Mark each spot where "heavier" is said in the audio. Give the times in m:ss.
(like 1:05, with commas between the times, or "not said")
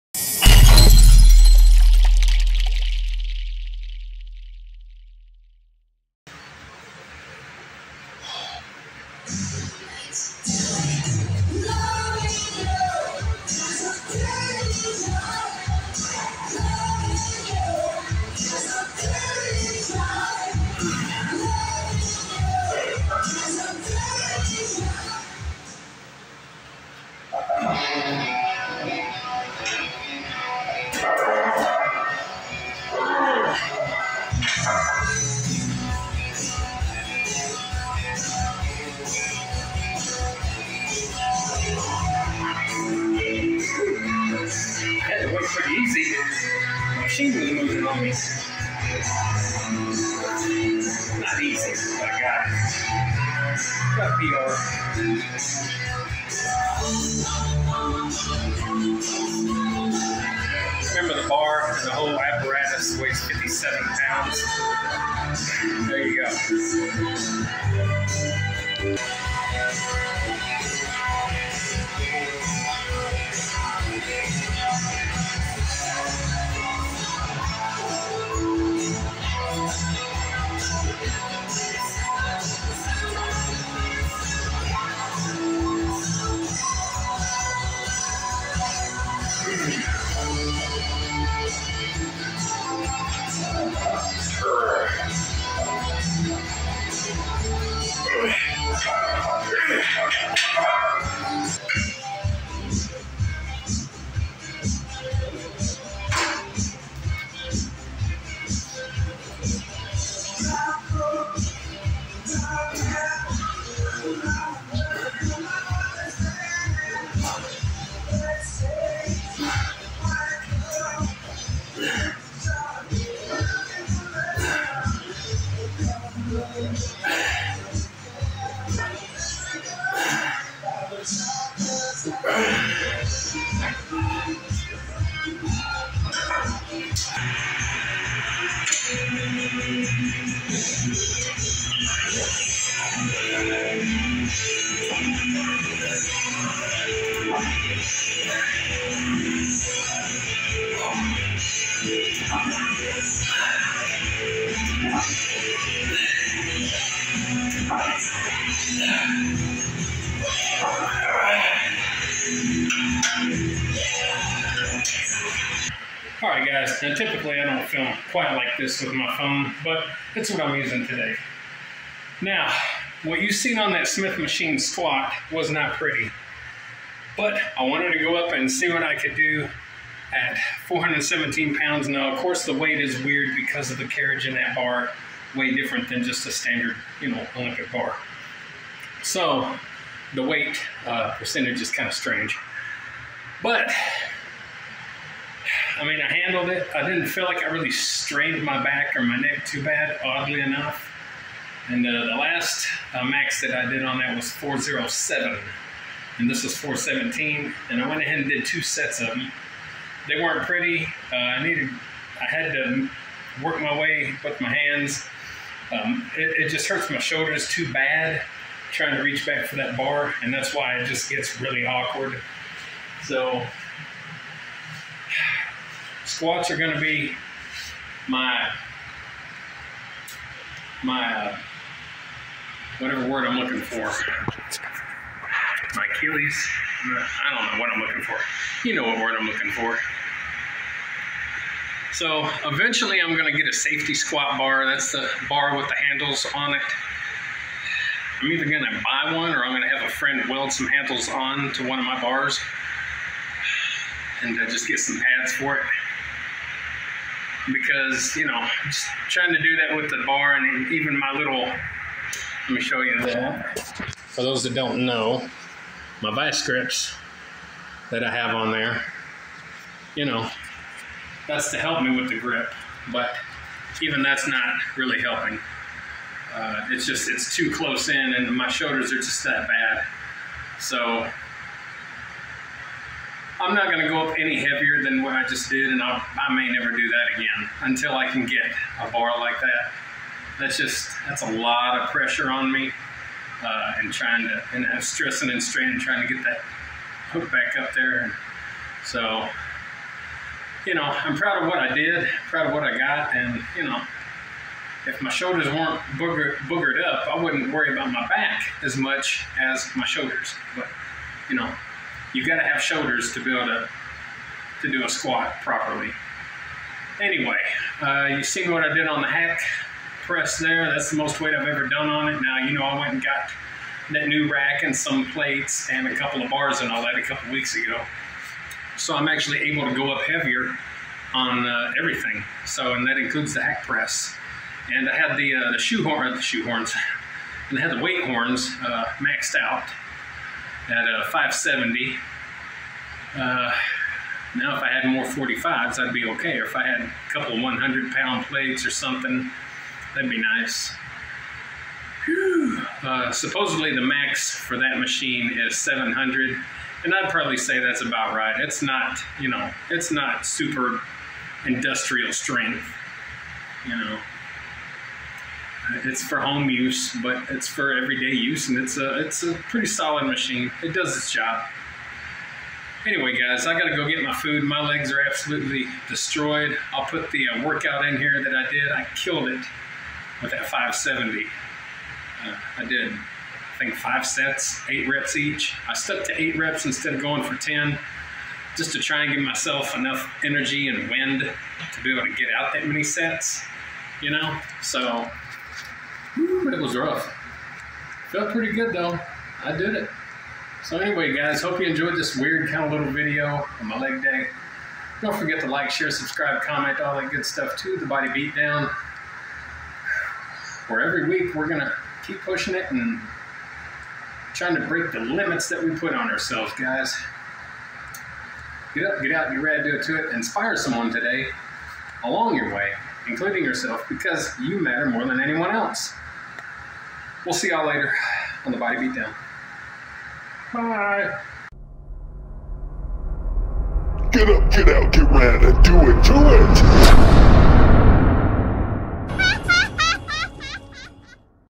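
4:44, 5:30.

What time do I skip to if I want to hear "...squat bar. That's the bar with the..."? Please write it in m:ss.
4:03.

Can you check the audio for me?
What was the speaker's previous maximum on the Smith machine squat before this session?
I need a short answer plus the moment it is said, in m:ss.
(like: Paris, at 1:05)
407, at 3:24.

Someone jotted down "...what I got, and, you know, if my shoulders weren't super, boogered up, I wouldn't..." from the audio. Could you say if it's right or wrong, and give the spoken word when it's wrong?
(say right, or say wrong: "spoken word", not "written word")
wrong: "booger", not "super".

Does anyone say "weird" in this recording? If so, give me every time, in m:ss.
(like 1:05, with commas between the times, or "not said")
3:03, 6:42.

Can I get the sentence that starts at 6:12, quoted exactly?
Anyway, guys, I gotta go get my food.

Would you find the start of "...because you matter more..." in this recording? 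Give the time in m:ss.
7:03.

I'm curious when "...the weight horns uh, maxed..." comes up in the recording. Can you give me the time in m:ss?
5:37.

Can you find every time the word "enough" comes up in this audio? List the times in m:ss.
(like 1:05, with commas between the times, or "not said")
3:20, 6:29.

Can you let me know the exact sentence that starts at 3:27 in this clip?
And I went ahead and did two sets of them.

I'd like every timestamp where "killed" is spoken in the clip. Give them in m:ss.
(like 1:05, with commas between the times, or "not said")
6:18.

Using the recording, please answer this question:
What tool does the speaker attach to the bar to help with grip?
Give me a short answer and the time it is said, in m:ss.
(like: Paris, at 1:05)
vice grips, at 4:26.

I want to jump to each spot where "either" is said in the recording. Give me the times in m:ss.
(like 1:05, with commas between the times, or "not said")
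4:08.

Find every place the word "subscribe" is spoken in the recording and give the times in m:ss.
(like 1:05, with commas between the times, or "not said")
6:45.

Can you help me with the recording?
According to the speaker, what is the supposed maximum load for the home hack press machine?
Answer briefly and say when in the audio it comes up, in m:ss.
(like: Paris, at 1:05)
700, at 5:55.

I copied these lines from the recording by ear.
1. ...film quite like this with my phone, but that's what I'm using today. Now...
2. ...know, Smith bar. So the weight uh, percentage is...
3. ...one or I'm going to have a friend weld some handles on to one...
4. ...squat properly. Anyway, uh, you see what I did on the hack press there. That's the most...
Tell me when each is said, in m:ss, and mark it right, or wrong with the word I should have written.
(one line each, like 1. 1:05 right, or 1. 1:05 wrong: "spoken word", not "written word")
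1. 2:47 right
2. 3:07 wrong: "Olympic", not "Smith"
3. 4:09 right
4. 5:14 right.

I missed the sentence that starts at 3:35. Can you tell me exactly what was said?
Um, it, it just hurts my shoulders too bad trying to reach back for that bar.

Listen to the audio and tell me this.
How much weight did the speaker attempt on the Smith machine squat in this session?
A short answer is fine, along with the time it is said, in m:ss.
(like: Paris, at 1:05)
417 pounds, at 3:00.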